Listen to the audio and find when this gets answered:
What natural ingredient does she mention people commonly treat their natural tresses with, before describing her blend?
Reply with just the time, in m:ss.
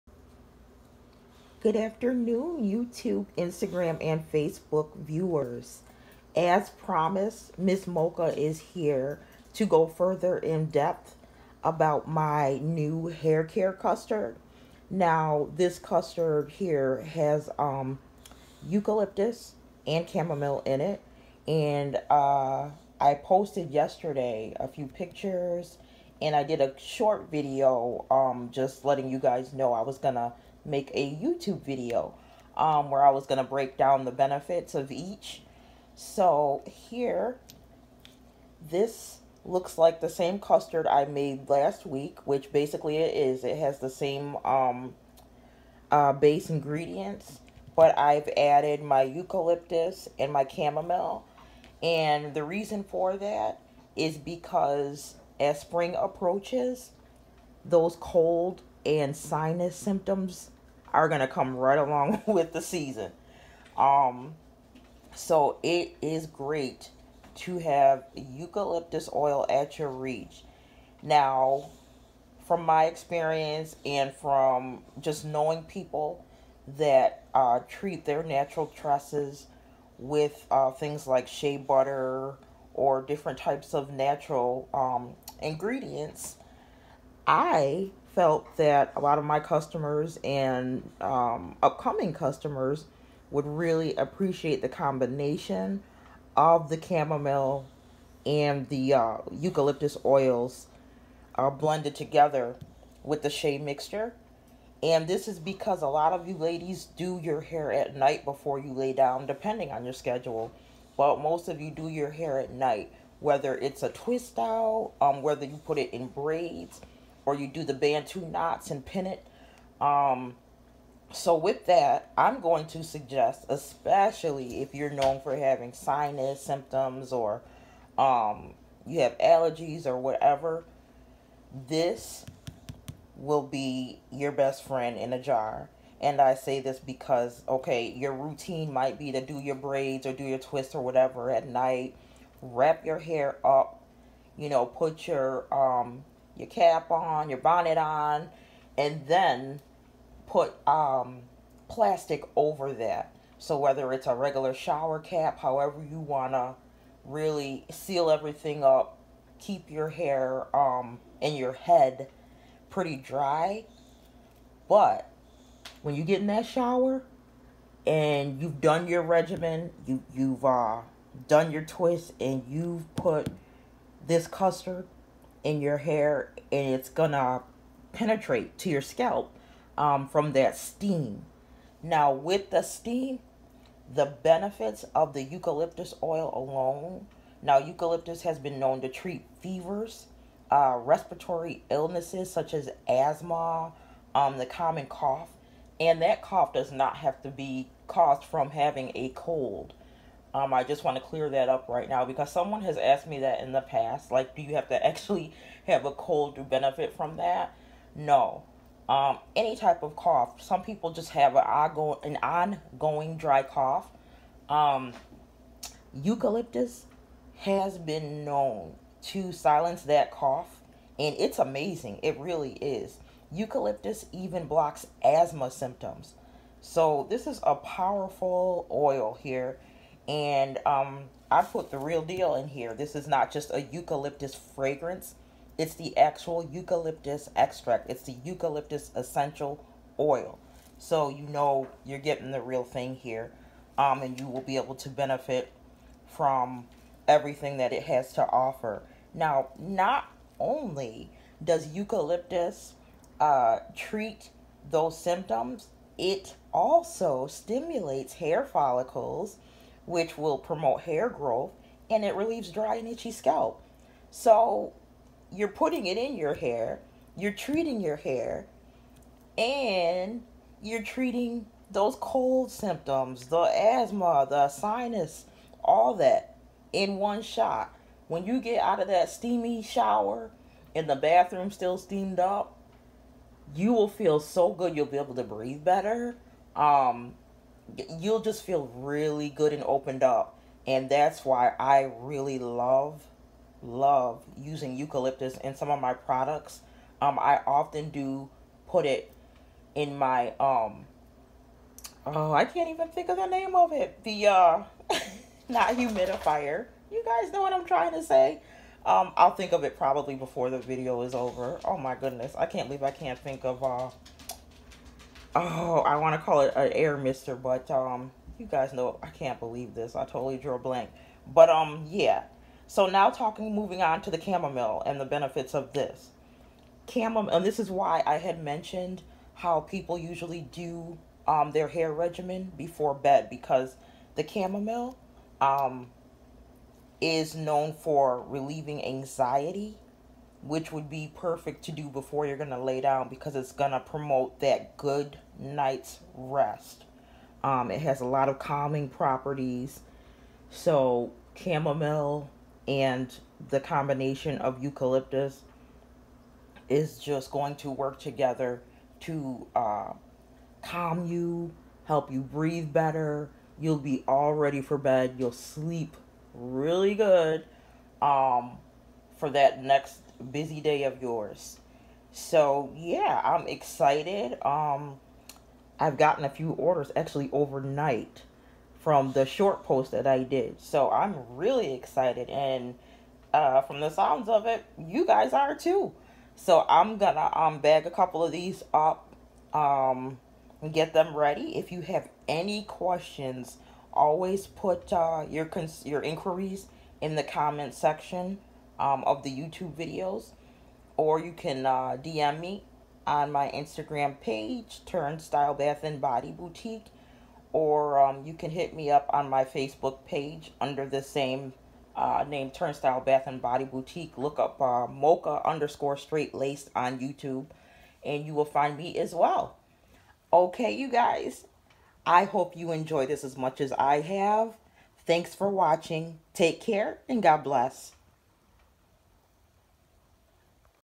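1:21.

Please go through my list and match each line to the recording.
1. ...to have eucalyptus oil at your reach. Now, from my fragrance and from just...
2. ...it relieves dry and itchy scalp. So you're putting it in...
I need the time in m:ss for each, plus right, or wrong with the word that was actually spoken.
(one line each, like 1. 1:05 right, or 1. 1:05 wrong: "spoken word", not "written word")
1. 1:07 wrong: "experience", not "fragrance"
2. 4:22 right.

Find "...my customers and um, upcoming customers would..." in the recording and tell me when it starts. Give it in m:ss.
1:29.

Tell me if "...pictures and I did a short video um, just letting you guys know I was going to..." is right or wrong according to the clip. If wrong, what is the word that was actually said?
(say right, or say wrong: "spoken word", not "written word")
right.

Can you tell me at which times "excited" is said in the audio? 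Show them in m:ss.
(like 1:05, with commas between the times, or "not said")
6:13, 6:21.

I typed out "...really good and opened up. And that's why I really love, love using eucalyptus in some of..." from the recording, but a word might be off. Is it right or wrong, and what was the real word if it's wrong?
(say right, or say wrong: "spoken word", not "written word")
right.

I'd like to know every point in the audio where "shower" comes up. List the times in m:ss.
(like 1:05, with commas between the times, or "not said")
2:34, 2:46, 4:39.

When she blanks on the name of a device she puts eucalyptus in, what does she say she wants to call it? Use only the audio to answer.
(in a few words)
Air mister.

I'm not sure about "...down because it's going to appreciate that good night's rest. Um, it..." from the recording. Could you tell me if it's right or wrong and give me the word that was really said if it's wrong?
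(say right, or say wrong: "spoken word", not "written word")
wrong: "promote", not "appreciate".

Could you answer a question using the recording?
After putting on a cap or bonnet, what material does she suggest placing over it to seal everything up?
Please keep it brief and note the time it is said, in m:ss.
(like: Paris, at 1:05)
Plastic, at 2:31.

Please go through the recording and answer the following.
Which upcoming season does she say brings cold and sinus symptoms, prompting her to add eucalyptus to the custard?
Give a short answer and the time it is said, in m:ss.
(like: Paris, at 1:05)
Spring, at 0:55.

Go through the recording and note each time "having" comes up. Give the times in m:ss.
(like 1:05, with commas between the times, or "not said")
2:05, 3:18.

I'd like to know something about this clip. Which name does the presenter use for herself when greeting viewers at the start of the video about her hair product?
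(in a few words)
Miss Mocha.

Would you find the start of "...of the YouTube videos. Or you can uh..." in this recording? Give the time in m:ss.
6:39.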